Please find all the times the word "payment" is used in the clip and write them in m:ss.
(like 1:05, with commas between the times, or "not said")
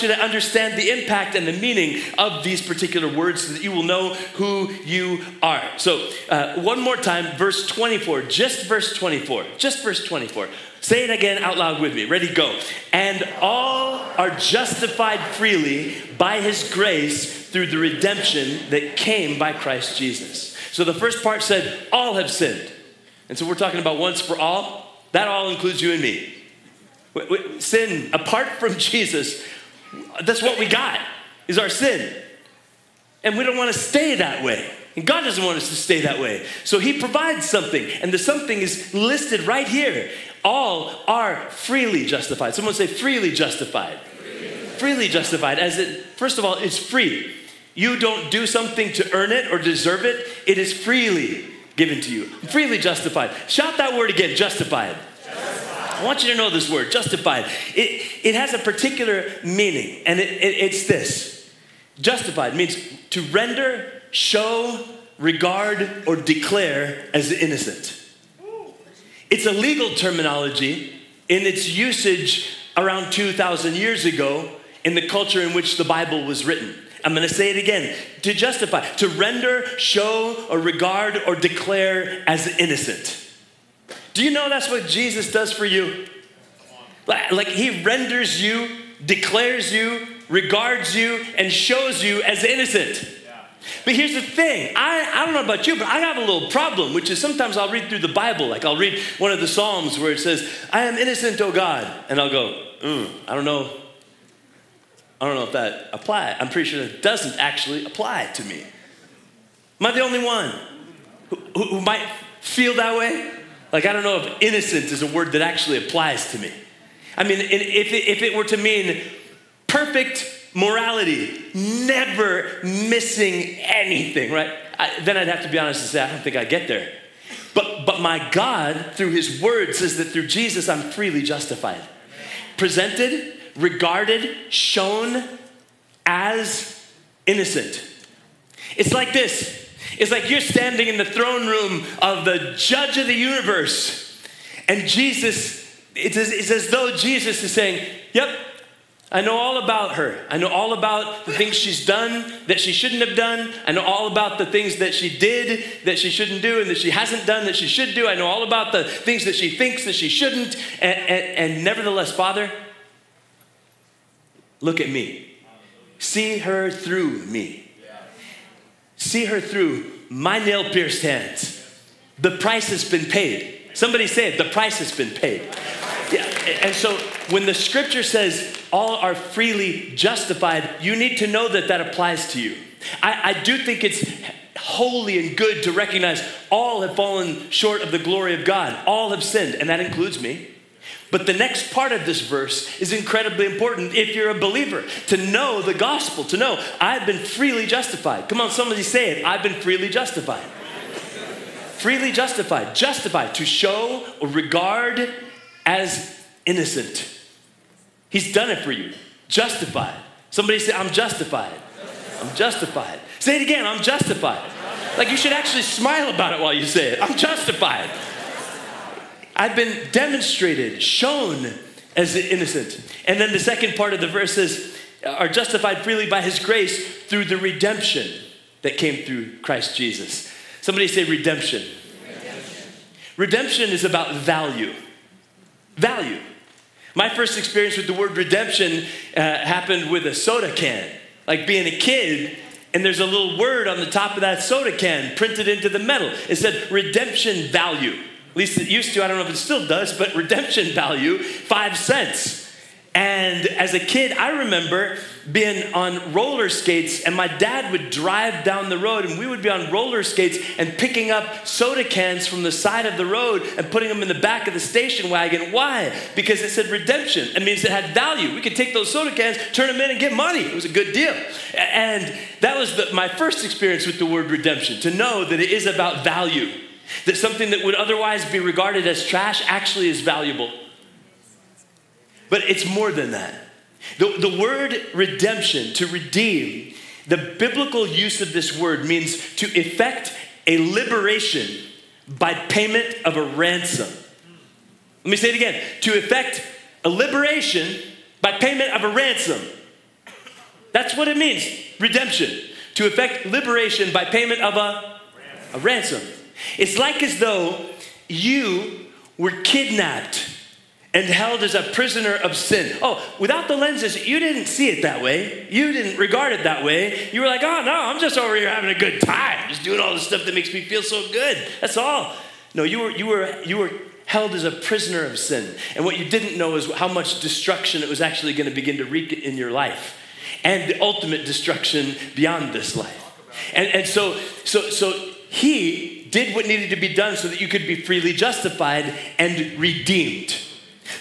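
4:52, 4:58, 5:04.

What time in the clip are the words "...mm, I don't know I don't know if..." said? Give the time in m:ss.
1:42.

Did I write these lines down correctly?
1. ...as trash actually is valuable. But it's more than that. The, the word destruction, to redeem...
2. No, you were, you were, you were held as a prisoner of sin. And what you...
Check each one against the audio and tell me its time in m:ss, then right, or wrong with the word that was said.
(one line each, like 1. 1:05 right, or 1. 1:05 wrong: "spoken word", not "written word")
1. 4:38 wrong: "redemption", not "destruction"
2. 5:22 right.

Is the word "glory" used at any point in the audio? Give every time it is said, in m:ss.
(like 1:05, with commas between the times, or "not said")
3:07.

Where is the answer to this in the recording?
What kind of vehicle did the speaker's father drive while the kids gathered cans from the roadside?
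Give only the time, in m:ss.
4:24.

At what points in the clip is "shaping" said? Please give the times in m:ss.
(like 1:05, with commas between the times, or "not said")
not said.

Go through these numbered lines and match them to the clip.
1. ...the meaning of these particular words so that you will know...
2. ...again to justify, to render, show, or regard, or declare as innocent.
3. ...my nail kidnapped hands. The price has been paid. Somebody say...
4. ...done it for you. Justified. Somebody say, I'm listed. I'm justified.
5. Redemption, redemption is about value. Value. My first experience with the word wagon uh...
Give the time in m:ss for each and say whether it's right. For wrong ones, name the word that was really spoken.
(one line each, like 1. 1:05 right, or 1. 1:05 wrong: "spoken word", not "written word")
1. 0:01 right
2. 1:17 right
3. 2:50 wrong: "pierced", not "kidnapped"
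4. 3:28 wrong: "justified", not "listed"
5. 3:52 wrong: "redemption", not "wagon".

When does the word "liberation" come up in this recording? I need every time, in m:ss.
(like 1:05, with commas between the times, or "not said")
4:50, 4:56, 5:03.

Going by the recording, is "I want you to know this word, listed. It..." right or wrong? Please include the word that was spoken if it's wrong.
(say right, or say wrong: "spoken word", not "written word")
wrong: "justified", not "listed".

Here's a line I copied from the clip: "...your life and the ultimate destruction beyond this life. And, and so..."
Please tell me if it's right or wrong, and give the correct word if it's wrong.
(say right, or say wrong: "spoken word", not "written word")
right.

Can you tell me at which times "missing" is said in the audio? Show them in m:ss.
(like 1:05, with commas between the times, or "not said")
2:02.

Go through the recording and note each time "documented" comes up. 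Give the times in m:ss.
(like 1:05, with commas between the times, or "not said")
not said.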